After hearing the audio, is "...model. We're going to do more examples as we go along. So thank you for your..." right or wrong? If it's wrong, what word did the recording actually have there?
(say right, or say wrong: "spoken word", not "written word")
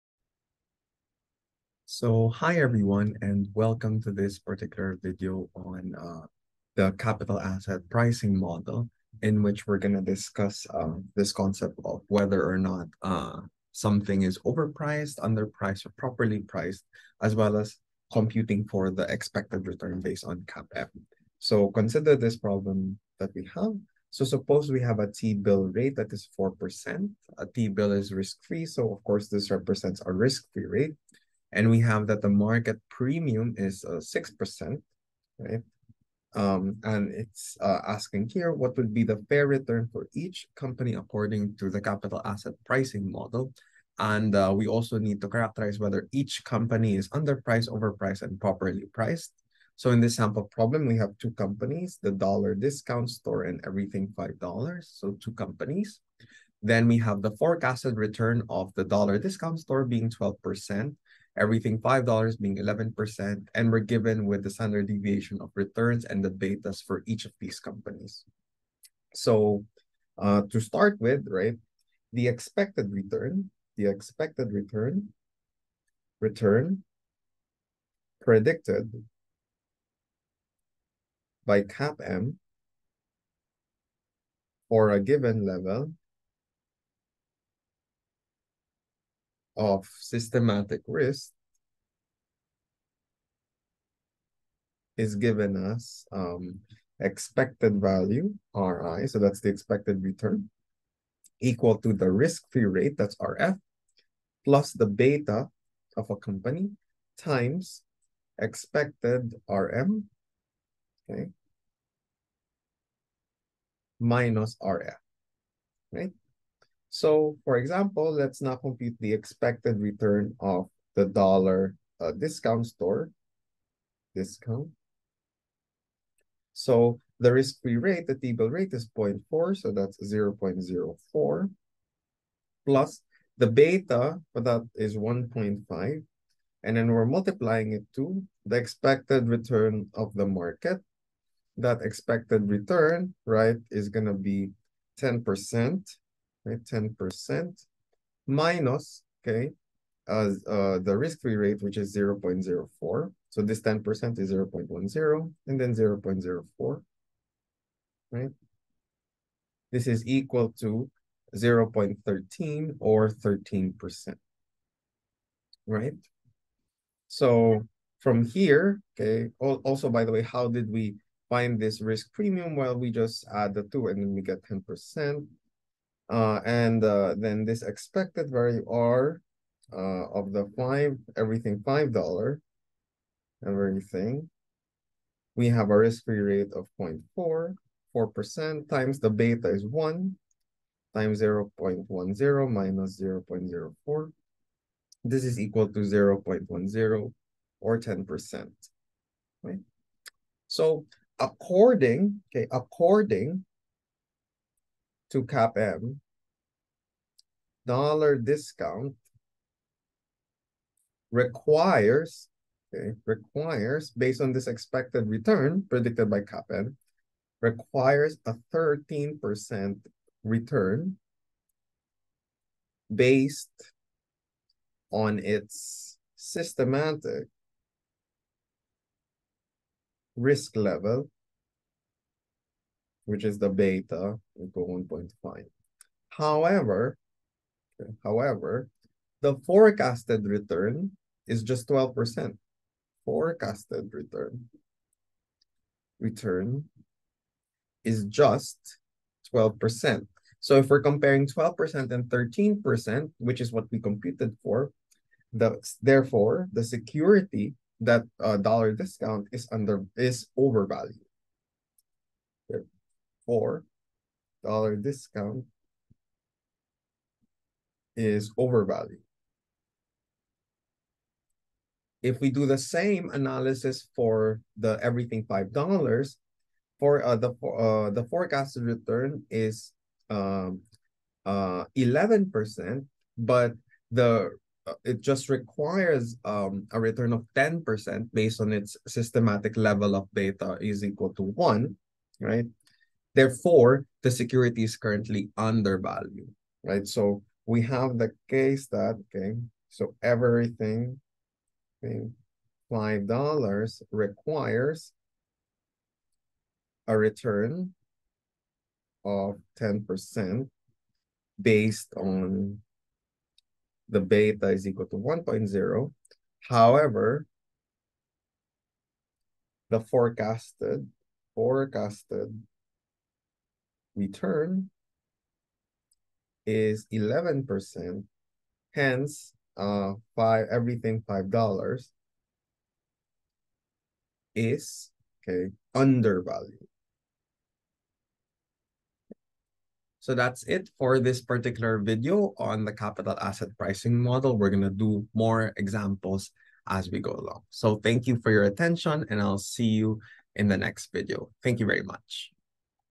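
right.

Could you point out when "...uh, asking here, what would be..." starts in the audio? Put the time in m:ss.
0:37.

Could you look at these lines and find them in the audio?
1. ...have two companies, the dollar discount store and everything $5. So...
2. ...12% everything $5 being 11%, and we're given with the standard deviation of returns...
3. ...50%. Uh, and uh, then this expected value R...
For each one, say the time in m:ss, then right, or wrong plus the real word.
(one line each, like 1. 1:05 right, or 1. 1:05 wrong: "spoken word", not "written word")
1. 0:50 right
2. 1:00 right
3. 2:54 wrong: "10", not "50".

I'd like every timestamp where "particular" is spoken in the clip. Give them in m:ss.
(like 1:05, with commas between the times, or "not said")
0:04, 5:41.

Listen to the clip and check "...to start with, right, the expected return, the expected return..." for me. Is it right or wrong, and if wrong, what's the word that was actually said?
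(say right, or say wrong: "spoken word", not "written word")
right.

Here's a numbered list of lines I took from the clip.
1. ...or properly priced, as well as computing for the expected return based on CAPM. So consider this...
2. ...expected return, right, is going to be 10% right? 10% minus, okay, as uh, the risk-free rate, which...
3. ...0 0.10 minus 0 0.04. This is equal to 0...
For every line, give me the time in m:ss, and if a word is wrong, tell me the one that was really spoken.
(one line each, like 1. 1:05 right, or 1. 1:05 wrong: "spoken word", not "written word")
1. 0:15 right
2. 2:21 right
3. 3:11 right.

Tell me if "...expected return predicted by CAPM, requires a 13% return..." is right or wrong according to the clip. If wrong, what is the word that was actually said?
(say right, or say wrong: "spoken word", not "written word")
right.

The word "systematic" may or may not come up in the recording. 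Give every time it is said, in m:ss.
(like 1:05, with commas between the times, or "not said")
1:29, 3:46, 4:48.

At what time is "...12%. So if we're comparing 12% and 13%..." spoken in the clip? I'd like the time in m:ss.
4:09.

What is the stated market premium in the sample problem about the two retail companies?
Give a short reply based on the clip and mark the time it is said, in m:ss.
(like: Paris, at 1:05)
6%, at 0:33.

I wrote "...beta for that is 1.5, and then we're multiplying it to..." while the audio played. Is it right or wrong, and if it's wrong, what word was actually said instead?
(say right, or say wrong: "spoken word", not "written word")
right.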